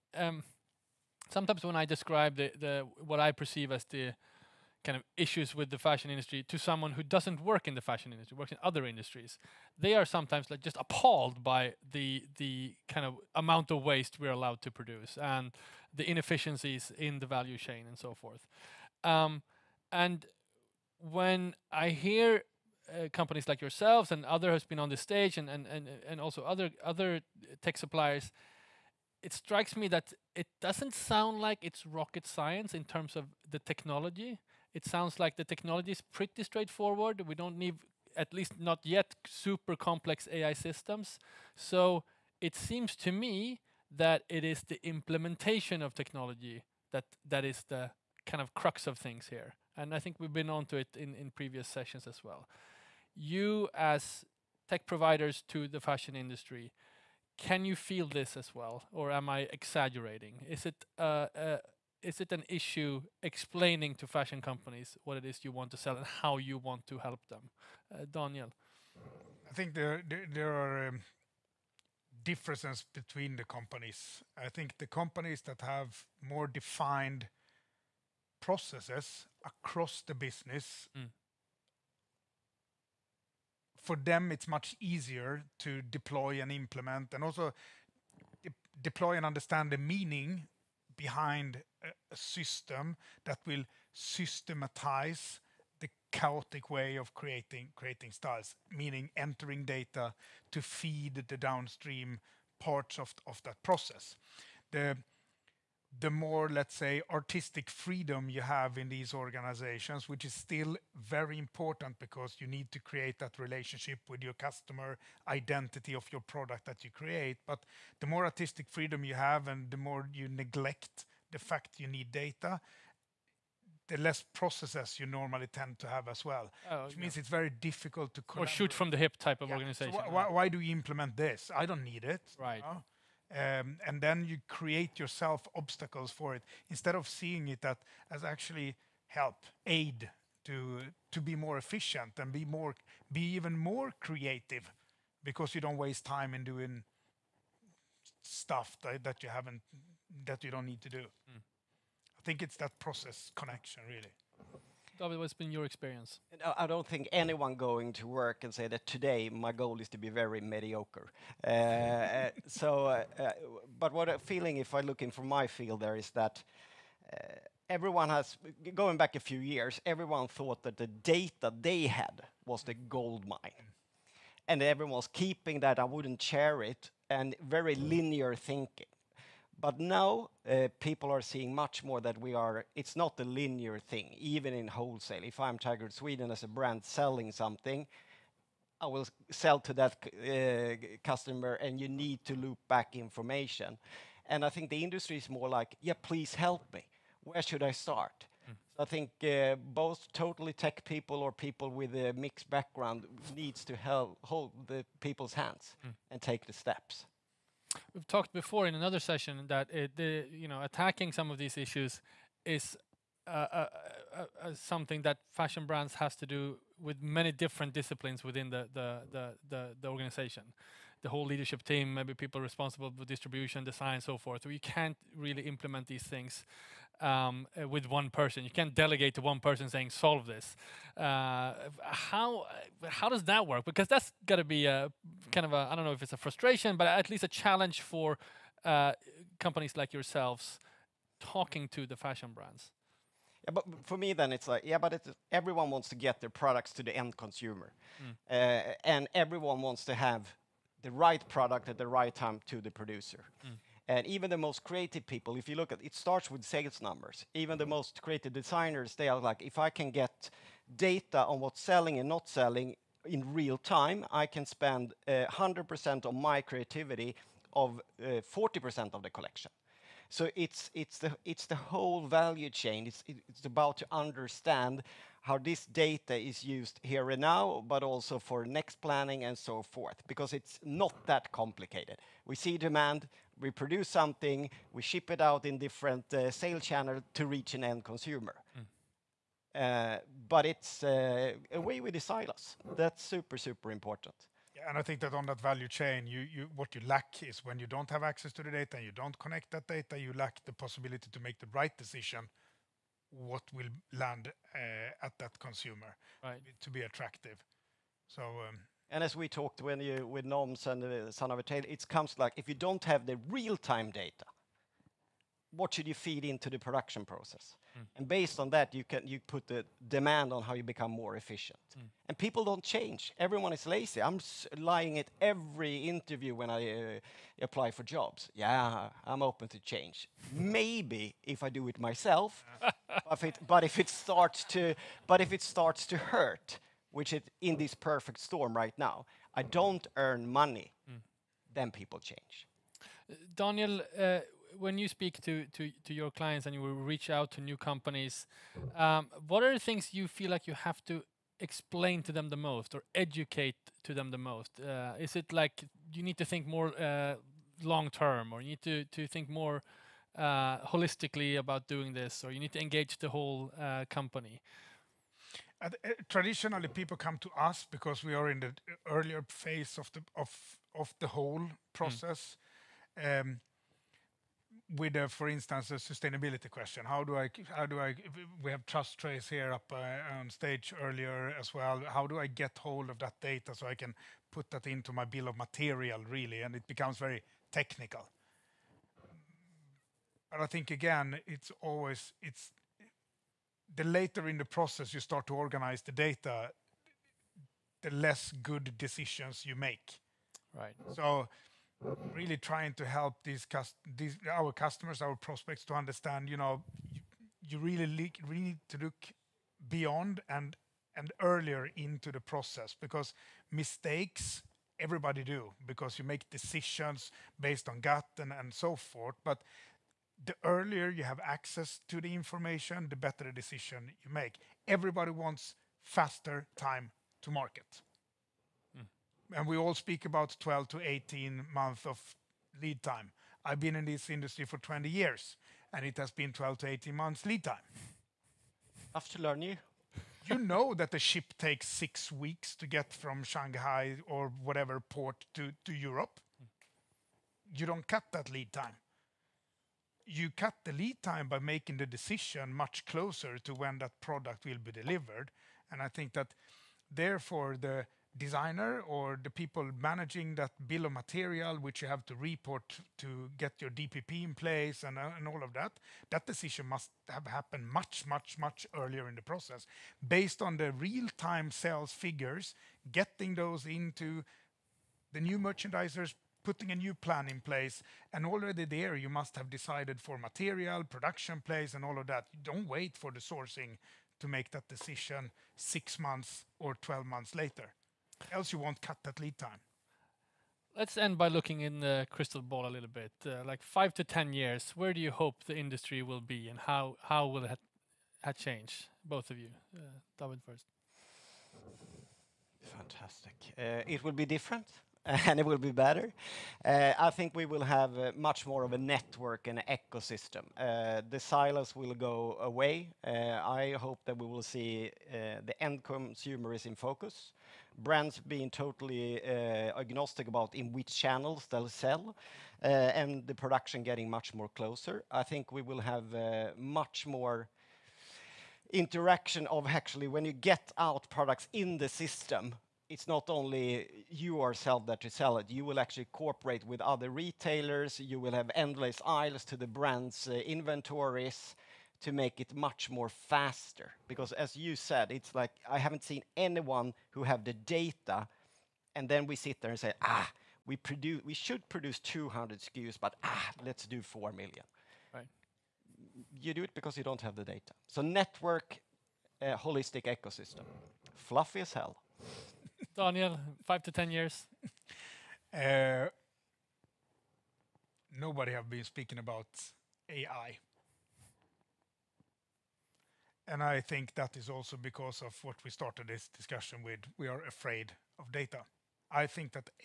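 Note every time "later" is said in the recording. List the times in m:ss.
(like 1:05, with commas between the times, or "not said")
6:33, 8:07.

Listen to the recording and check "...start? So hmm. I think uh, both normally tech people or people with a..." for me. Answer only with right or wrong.
wrong.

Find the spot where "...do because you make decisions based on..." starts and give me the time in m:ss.
6:55.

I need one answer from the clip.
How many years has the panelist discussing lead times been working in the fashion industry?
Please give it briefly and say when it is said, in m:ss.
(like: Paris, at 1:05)
20 years, at 7:14.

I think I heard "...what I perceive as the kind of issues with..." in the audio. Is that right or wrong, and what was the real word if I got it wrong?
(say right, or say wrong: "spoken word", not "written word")
right.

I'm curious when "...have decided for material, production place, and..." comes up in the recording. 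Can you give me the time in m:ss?
7:59.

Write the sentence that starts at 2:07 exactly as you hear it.
means it's very difficult to or shoot from the hip type of yeah.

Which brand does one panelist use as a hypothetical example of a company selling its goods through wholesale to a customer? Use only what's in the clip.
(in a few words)
Tiger Sweden.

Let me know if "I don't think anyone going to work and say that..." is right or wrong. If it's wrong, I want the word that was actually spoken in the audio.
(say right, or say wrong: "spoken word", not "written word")
right.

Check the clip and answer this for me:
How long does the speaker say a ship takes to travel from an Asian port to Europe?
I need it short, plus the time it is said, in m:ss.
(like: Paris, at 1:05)
6 weeks, at 7:21.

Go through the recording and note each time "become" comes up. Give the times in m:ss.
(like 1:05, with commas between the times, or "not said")
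5:20, 6:26.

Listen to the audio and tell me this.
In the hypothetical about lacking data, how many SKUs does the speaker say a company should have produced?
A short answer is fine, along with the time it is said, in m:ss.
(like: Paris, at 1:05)
200, at 9:11.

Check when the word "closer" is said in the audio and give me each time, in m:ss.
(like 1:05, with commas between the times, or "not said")
7:32, 8:44.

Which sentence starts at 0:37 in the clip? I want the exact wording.
We don't need, at least not yet, super complex AI systems.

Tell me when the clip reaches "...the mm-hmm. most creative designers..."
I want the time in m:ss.
4:17.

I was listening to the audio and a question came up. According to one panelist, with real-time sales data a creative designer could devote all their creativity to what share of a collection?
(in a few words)
40%.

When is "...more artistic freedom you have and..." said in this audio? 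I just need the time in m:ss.
1:58.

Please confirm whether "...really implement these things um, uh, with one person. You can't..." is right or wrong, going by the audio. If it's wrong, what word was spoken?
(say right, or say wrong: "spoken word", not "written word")
right.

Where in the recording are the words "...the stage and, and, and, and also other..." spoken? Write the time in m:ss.
0:24.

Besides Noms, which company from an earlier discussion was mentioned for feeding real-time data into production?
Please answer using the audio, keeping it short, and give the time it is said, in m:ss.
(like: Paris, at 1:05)
Son of a Tailor, at 5:11.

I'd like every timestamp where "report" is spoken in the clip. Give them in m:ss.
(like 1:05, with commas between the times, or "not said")
7:42.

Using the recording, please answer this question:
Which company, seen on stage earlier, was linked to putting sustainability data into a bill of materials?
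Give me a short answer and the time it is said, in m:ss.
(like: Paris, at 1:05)
TrusTrace, at 6:18.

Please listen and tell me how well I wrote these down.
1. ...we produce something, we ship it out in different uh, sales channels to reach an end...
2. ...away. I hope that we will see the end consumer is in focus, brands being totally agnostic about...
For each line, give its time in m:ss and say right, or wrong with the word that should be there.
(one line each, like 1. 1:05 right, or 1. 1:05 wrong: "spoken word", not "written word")
1. 4:43 right
2. 8:32 right.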